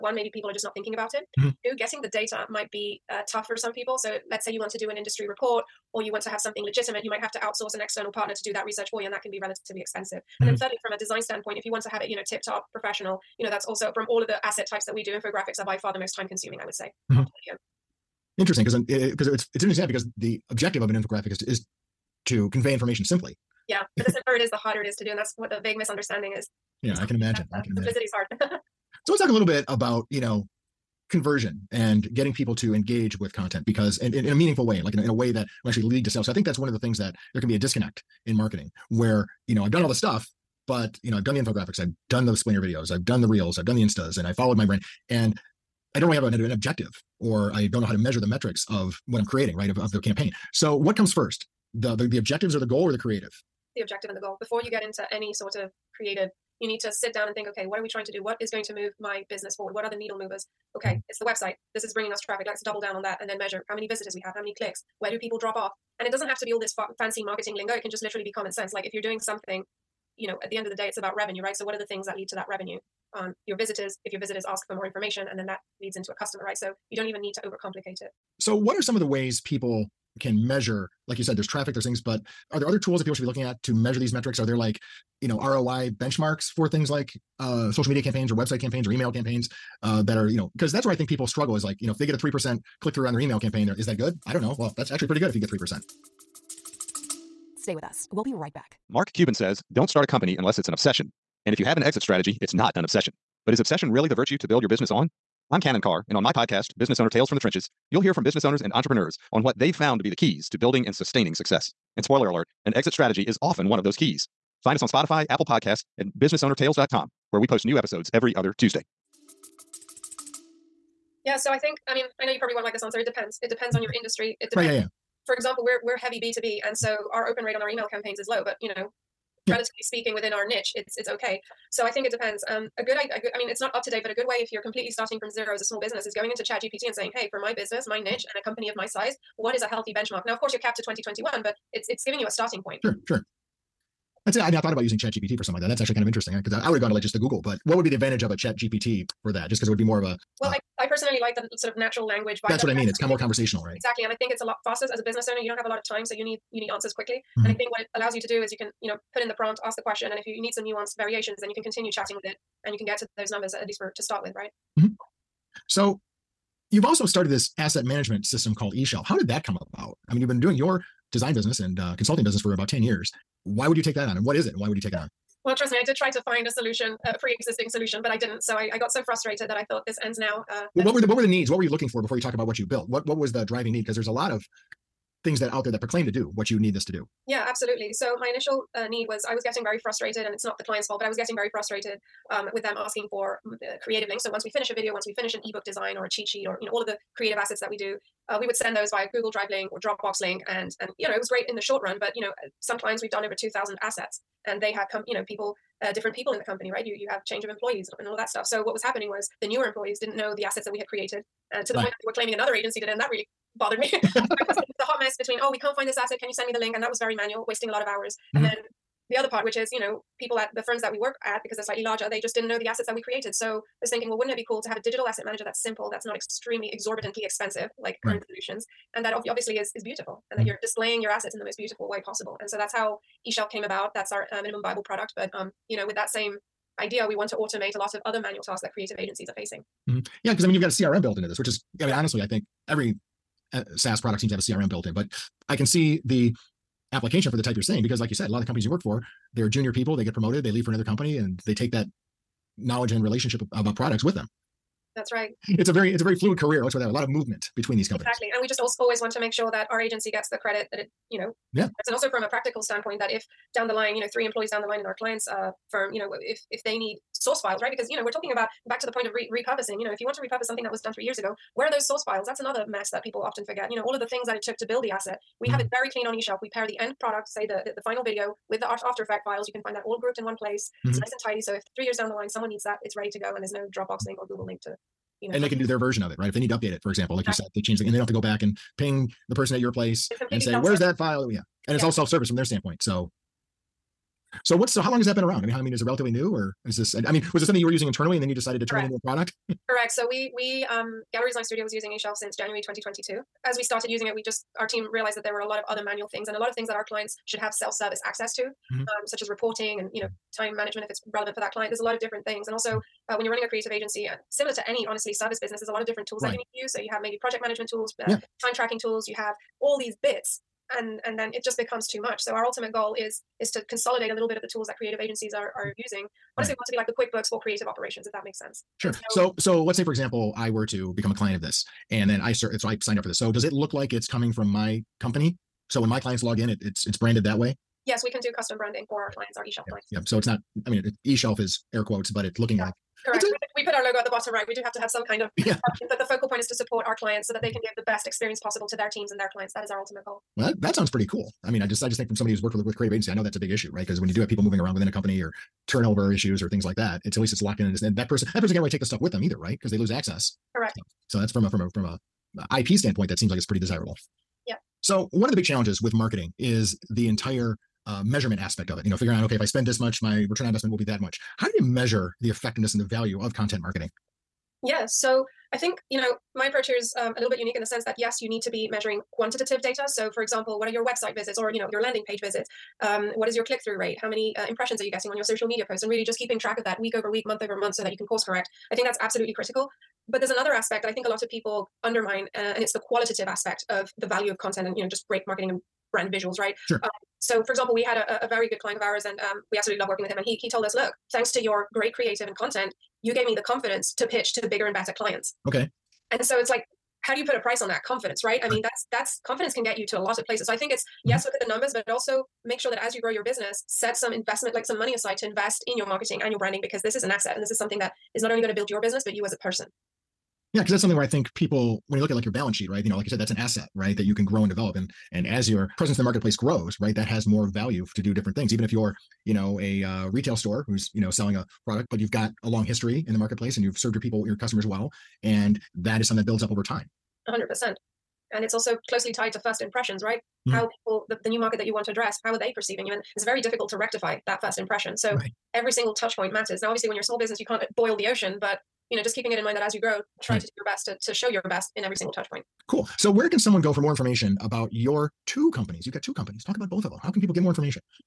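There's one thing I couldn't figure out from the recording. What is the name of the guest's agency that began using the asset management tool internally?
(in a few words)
Gallery Design Studio.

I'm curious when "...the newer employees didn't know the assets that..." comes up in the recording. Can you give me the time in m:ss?
3:29.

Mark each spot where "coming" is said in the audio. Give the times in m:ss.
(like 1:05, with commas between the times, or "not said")
5:34.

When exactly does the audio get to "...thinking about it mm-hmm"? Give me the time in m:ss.
0:00.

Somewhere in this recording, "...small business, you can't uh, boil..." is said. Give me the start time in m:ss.
7:27.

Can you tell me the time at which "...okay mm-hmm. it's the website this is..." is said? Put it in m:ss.
1:00.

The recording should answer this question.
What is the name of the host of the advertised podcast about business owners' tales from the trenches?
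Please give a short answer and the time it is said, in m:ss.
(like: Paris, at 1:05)
Canon Carr, at 1:45.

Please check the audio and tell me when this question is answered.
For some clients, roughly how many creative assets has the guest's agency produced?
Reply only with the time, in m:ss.
3:23.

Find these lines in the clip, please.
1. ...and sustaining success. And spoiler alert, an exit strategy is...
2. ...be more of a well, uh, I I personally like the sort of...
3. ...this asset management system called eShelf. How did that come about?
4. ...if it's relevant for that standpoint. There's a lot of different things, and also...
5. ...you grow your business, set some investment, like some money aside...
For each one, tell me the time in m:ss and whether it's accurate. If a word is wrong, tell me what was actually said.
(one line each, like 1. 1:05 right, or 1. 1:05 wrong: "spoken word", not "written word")
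1. 1:50 right
2. 2:29 right
3. 2:47 right
4. 5:10 wrong: "client", not "standpoint"
5. 6:52 right.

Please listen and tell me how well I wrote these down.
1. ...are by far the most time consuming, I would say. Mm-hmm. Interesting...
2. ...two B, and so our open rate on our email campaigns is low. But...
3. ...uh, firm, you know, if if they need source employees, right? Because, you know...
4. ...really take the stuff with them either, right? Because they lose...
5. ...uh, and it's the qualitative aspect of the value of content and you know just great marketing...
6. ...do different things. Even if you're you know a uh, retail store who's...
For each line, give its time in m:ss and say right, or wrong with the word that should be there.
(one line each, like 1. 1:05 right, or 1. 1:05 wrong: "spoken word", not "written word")
1. 0:15 right
2. 2:06 right
3. 4:25 wrong: "files", not "employees"
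4. 5:58 right
5. 6:32 right
6. 7:08 right.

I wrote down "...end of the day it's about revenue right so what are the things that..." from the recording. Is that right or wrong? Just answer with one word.
right.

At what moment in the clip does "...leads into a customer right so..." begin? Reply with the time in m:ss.
1:15.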